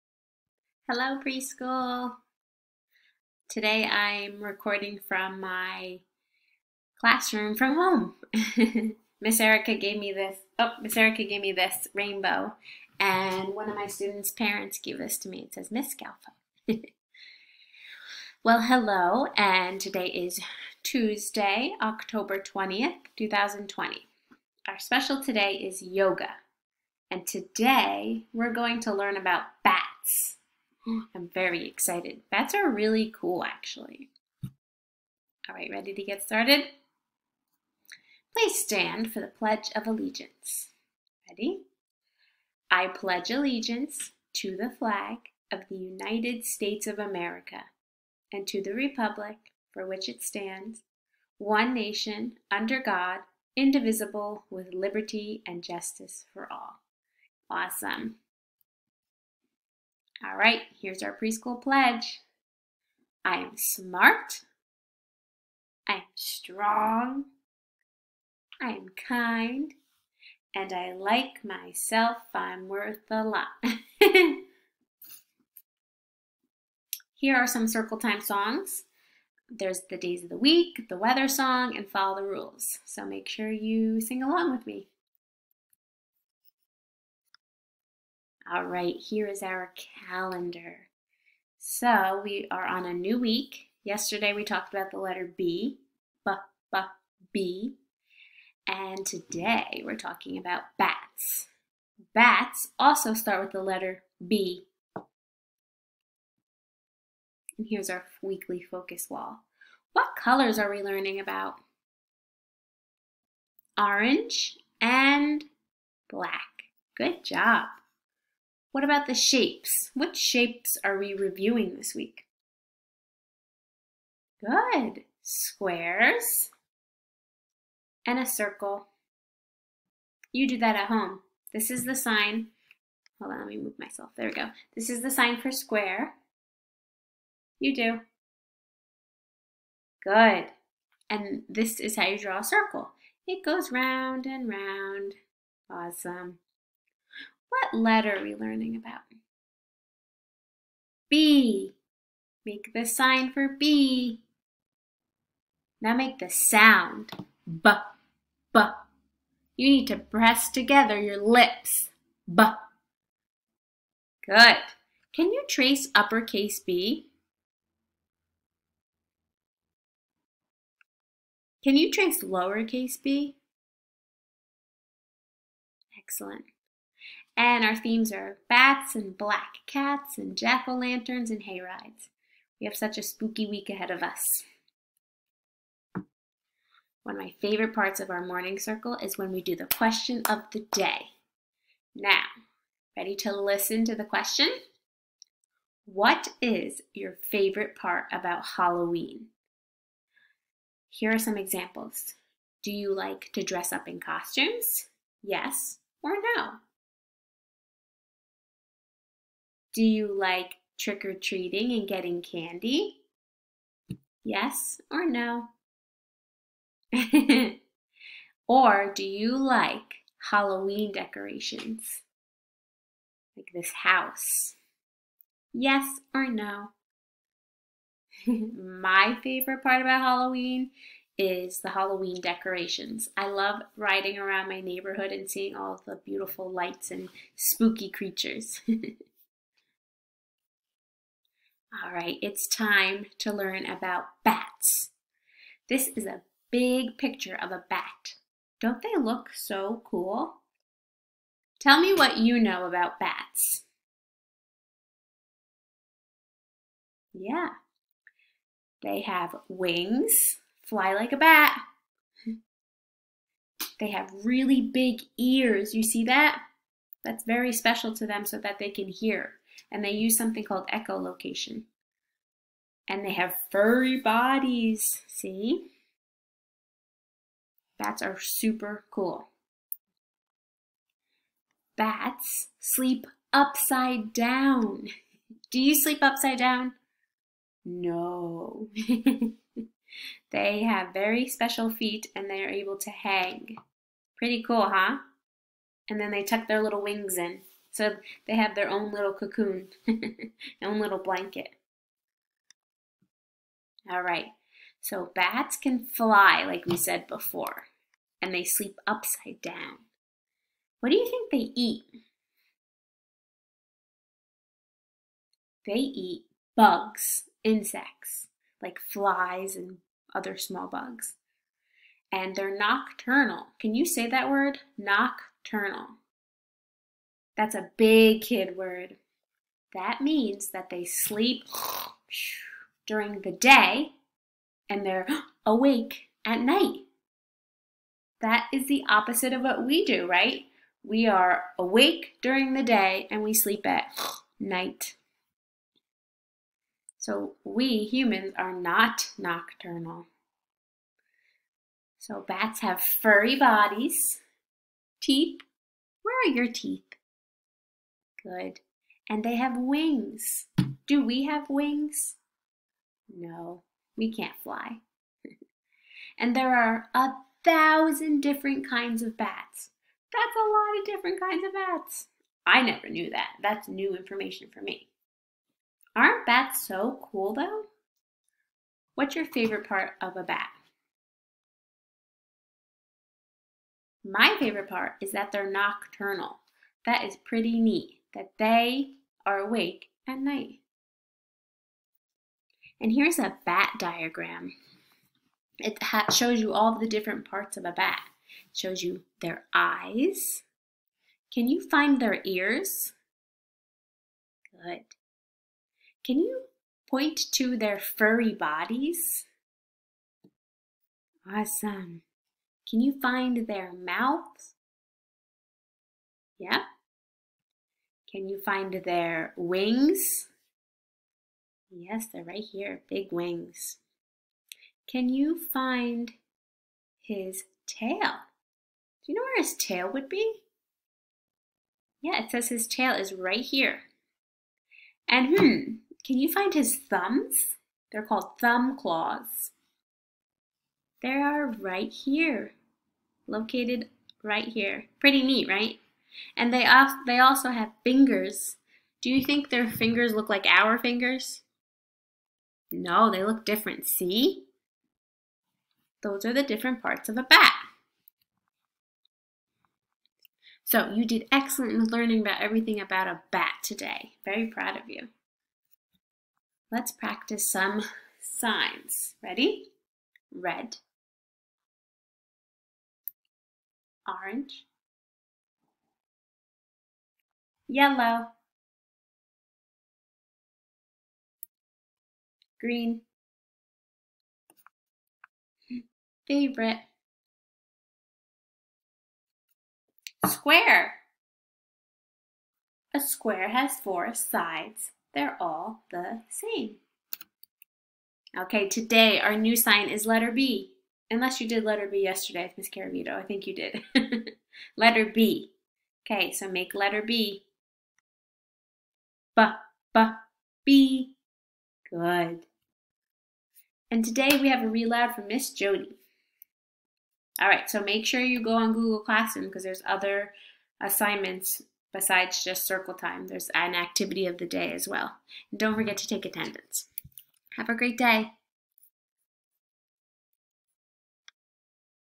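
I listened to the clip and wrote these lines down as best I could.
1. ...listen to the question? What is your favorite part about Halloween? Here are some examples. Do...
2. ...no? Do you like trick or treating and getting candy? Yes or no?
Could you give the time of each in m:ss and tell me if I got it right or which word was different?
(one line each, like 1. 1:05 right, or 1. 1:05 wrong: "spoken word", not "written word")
1. 3:13 right
2. 3:26 right.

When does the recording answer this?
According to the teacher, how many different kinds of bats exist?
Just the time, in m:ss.
6:06.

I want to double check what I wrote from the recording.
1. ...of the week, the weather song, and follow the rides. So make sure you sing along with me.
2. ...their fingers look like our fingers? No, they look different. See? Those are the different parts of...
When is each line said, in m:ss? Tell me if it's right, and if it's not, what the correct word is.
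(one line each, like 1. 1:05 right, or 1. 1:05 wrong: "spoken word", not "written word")
1. 1:20 wrong: "rules", not "rides"
2. 7:29 right.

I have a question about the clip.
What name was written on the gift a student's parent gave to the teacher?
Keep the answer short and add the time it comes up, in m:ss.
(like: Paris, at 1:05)
Miss Galfo, at 0:15.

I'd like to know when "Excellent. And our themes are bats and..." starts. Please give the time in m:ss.
2:55.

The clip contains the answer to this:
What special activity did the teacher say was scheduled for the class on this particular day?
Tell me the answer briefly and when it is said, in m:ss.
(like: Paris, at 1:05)
Yoga, at 0:25.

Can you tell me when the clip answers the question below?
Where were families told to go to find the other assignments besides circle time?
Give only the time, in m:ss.
8:38.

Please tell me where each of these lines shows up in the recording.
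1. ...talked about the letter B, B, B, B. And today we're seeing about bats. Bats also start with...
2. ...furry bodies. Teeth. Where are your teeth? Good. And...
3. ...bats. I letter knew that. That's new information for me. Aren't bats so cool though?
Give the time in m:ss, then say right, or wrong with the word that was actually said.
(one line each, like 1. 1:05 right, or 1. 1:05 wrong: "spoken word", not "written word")
1. 1:34 wrong: "talking", not "seeing"
2. 5:52 right
3. 6:11 wrong: "never", not "letter".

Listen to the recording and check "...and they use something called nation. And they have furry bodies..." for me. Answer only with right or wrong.
wrong.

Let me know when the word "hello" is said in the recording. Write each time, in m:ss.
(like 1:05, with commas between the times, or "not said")
0:00, 0:18.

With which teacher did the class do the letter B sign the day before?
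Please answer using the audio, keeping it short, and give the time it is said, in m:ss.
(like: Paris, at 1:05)
Miss Caravito, at 8:22.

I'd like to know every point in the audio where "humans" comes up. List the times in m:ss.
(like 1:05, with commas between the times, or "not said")
5:47.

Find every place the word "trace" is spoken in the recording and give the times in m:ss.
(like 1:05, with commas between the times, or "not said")
2:45, 2:51.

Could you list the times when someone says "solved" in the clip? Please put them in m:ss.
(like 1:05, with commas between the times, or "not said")
not said.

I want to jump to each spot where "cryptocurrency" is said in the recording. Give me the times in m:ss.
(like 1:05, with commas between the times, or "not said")
not said.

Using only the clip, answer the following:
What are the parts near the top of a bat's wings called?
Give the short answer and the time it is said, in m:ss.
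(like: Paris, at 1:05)
Thumb claws, at 7:18.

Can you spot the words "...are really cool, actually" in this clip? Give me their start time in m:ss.
0:32.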